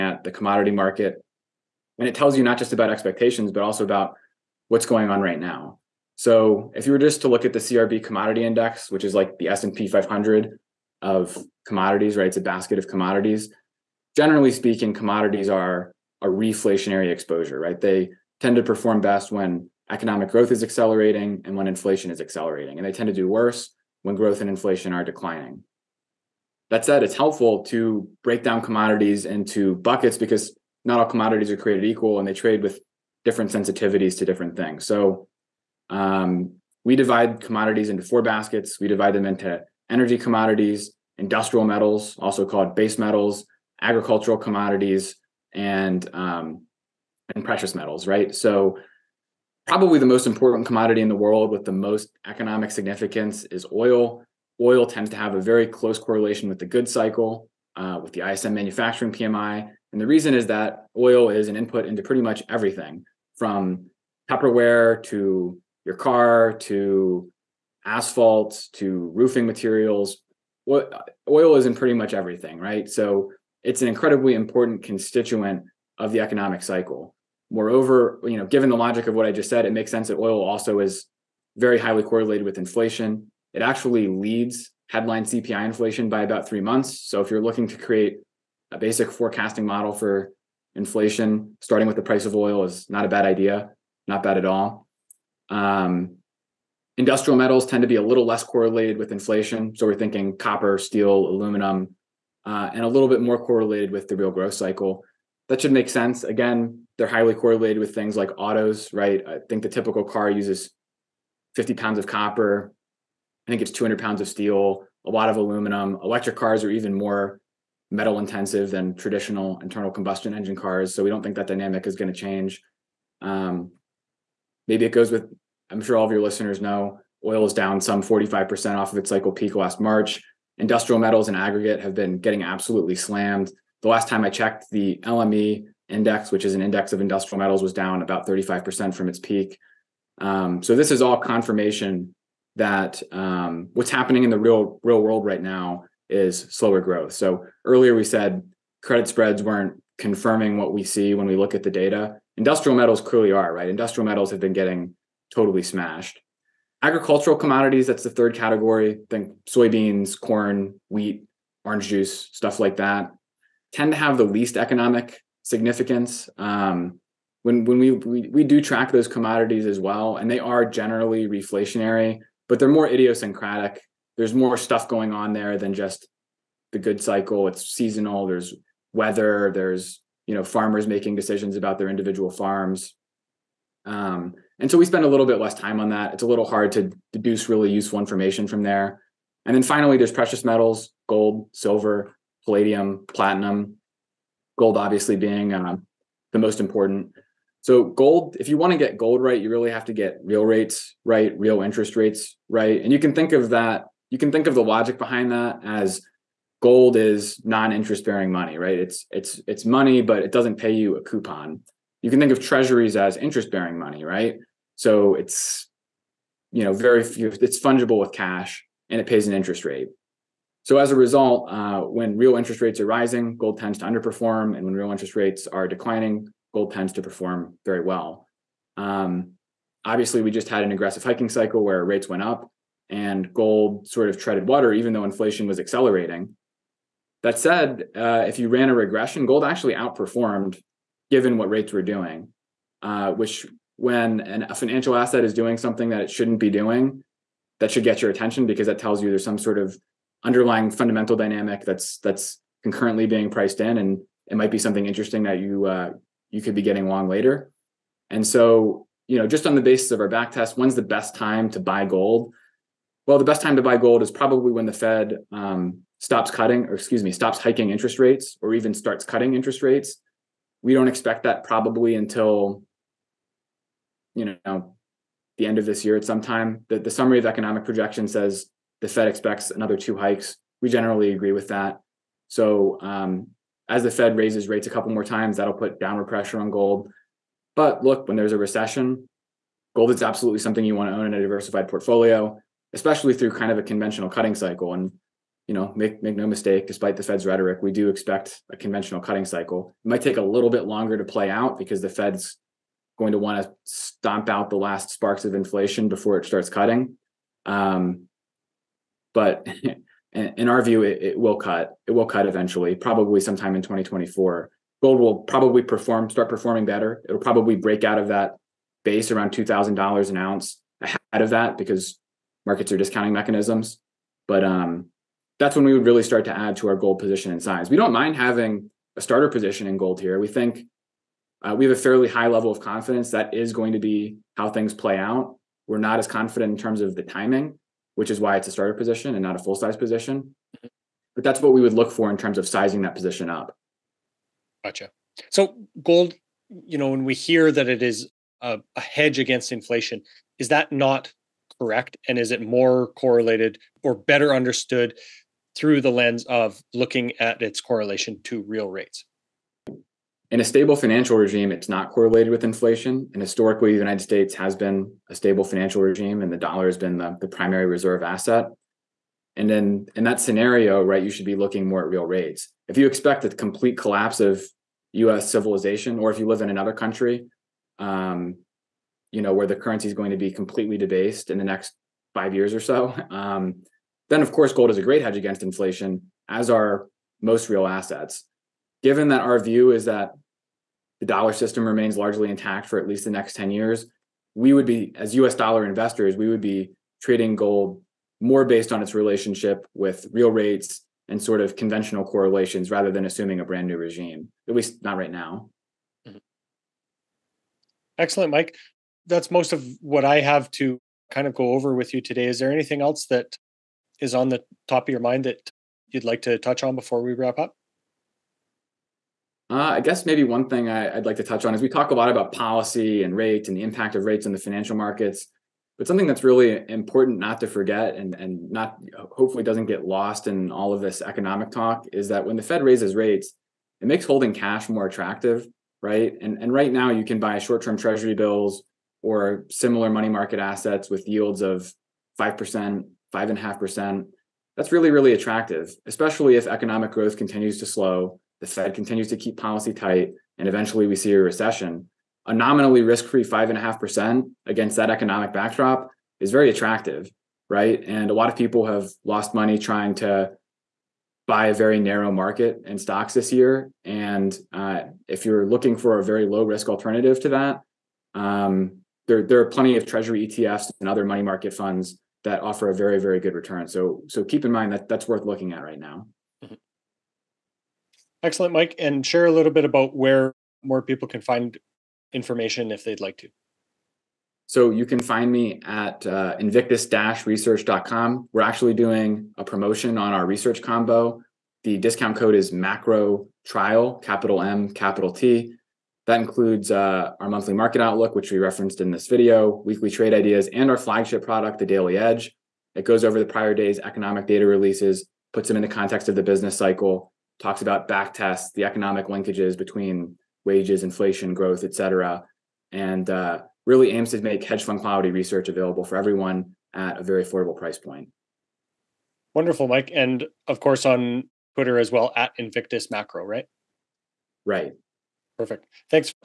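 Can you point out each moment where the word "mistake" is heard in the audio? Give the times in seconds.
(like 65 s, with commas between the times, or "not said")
296 s.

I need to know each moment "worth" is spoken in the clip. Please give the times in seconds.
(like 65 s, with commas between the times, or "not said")
475 s.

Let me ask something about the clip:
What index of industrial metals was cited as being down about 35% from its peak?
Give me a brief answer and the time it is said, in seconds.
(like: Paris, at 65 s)
LME index, at 134 s.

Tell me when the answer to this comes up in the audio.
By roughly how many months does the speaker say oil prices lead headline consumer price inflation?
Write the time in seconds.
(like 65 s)
86 s.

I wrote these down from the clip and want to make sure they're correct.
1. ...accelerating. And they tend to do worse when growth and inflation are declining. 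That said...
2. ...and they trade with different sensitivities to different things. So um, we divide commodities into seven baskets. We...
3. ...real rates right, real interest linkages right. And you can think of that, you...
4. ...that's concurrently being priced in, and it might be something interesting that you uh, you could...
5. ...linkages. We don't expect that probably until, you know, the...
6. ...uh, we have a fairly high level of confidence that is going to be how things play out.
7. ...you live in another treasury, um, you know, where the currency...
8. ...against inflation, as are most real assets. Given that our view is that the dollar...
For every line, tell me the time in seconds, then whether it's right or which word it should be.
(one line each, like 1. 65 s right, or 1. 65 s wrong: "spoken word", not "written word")
1. 22 s right
2. 32 s wrong: "four", not "seven"
3. 200 s wrong: "rates", not "linkages"
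4. 251 s right
5. 269 s wrong: "rates", not "linkages"
6. 331 s right
7. 376 s wrong: "country", not "treasury"
8. 385 s right.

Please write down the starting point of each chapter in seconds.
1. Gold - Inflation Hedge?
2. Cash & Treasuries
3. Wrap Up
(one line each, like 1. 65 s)
1. 344 s
2. 416 s
3. 476 s.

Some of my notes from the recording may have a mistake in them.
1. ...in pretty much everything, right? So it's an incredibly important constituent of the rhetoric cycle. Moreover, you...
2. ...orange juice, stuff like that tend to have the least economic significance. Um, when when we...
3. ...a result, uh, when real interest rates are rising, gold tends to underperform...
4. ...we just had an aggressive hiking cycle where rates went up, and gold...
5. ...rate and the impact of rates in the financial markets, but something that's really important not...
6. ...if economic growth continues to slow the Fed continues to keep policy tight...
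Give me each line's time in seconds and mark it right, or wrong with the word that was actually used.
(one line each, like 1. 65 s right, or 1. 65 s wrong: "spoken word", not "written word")
1. 71 s wrong: "economic", not "rhetoric"
2. 161 s right
3. 220 s right
4. 230 s right
5. 423 s right
6. 446 s right.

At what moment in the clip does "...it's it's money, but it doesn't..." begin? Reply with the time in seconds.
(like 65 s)
209 s.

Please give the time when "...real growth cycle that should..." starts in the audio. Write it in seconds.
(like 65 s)
104 s.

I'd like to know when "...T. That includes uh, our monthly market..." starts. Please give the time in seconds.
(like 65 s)
495 s.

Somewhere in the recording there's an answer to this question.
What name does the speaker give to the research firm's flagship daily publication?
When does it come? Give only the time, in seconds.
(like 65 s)
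501 s.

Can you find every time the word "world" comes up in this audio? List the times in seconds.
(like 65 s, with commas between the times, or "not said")
51 s, 145 s.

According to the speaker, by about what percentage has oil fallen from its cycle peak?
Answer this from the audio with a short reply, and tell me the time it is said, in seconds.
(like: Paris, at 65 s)
45%, at 128 s.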